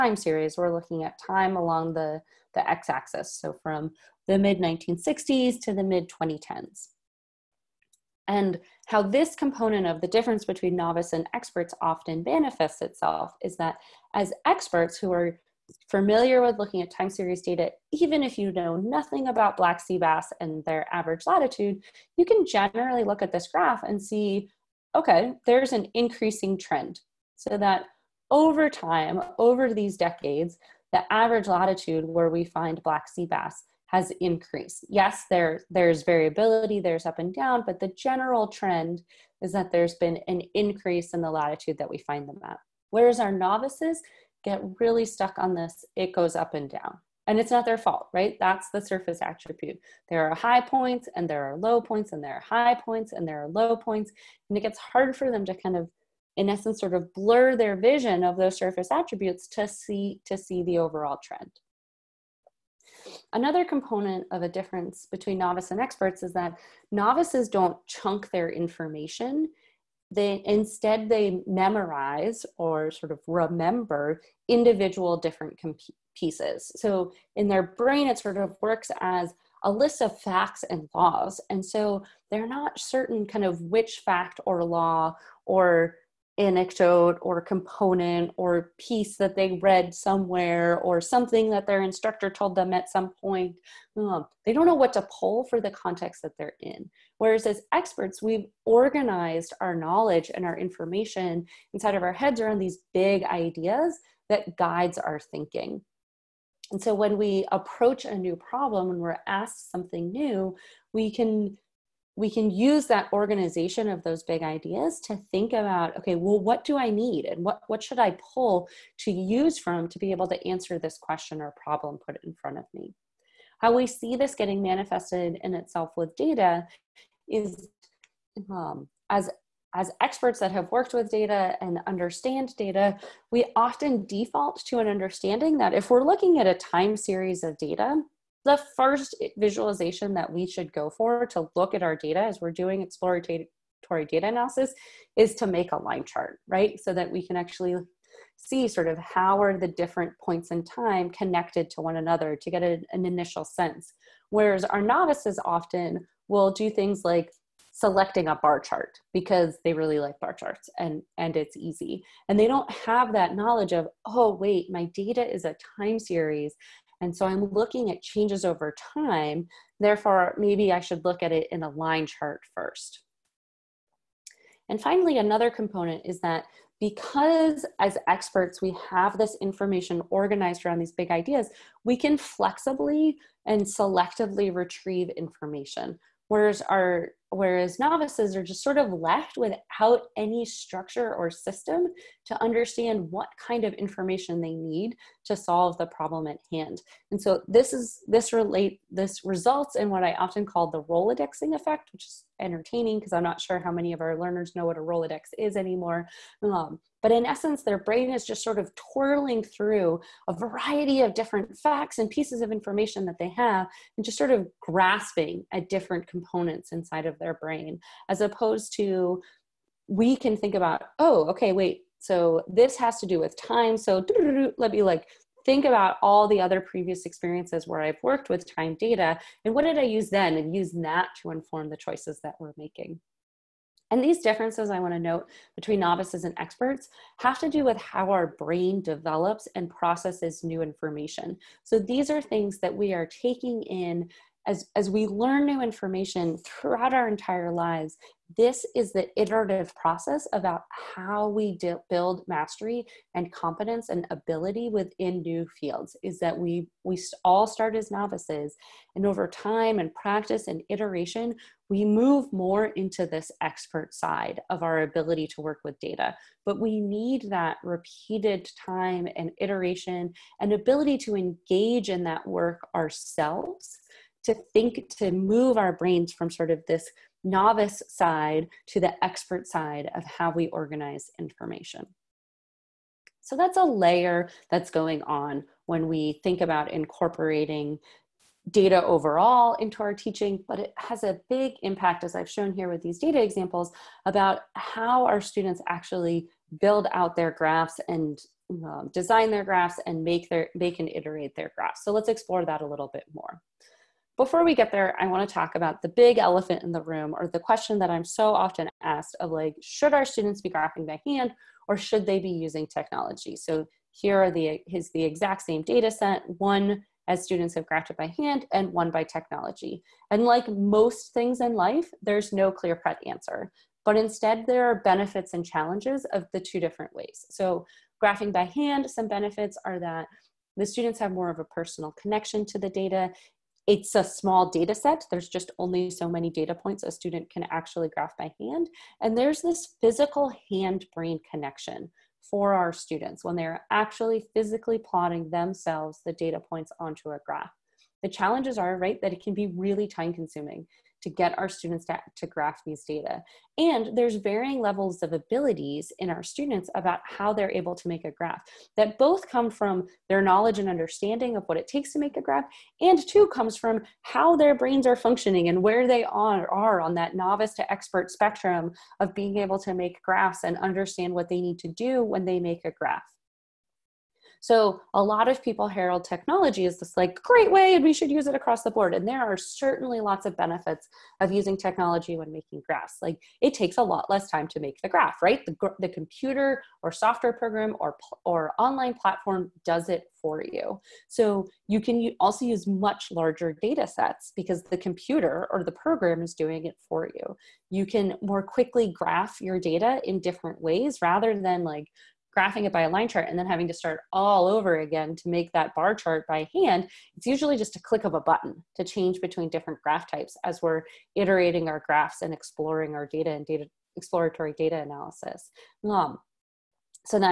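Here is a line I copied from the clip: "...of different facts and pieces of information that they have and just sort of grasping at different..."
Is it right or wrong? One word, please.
right.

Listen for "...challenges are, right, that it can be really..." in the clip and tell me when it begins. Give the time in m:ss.
5:48.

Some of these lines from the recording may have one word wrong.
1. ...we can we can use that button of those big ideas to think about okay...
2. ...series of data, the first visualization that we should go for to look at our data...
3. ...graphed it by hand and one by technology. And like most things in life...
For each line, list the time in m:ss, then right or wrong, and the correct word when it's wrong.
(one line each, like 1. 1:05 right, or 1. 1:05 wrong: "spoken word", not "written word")
1. 1:50 wrong: "organization", not "button"
2. 2:16 right
3. 5:17 right.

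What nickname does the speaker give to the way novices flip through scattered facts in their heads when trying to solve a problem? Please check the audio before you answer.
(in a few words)
Rolodexing effect.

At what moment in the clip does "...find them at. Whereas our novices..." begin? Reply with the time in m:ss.
0:41.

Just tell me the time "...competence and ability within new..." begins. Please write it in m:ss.
4:13.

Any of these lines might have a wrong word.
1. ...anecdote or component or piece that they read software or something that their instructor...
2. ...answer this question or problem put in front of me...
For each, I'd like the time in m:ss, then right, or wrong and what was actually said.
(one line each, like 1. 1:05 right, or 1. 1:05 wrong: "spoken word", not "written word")
1. 1:26 wrong: "somewhere", not "software"
2. 2:00 right.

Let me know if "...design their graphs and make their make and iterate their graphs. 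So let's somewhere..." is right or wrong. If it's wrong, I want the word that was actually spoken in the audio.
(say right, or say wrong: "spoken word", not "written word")
wrong: "explore", not "somewhere".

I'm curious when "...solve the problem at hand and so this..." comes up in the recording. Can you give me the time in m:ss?
3:15.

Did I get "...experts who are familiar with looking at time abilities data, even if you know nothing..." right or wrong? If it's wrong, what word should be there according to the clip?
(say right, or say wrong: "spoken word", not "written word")
wrong: "series", not "abilities".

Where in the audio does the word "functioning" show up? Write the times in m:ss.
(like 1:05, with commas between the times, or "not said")
6:04.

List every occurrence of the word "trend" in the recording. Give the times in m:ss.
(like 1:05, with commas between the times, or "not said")
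0:26, 0:38, 1:01.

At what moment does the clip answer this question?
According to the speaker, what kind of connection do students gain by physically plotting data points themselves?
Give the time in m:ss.
5:40.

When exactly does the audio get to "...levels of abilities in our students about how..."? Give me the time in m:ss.
5:54.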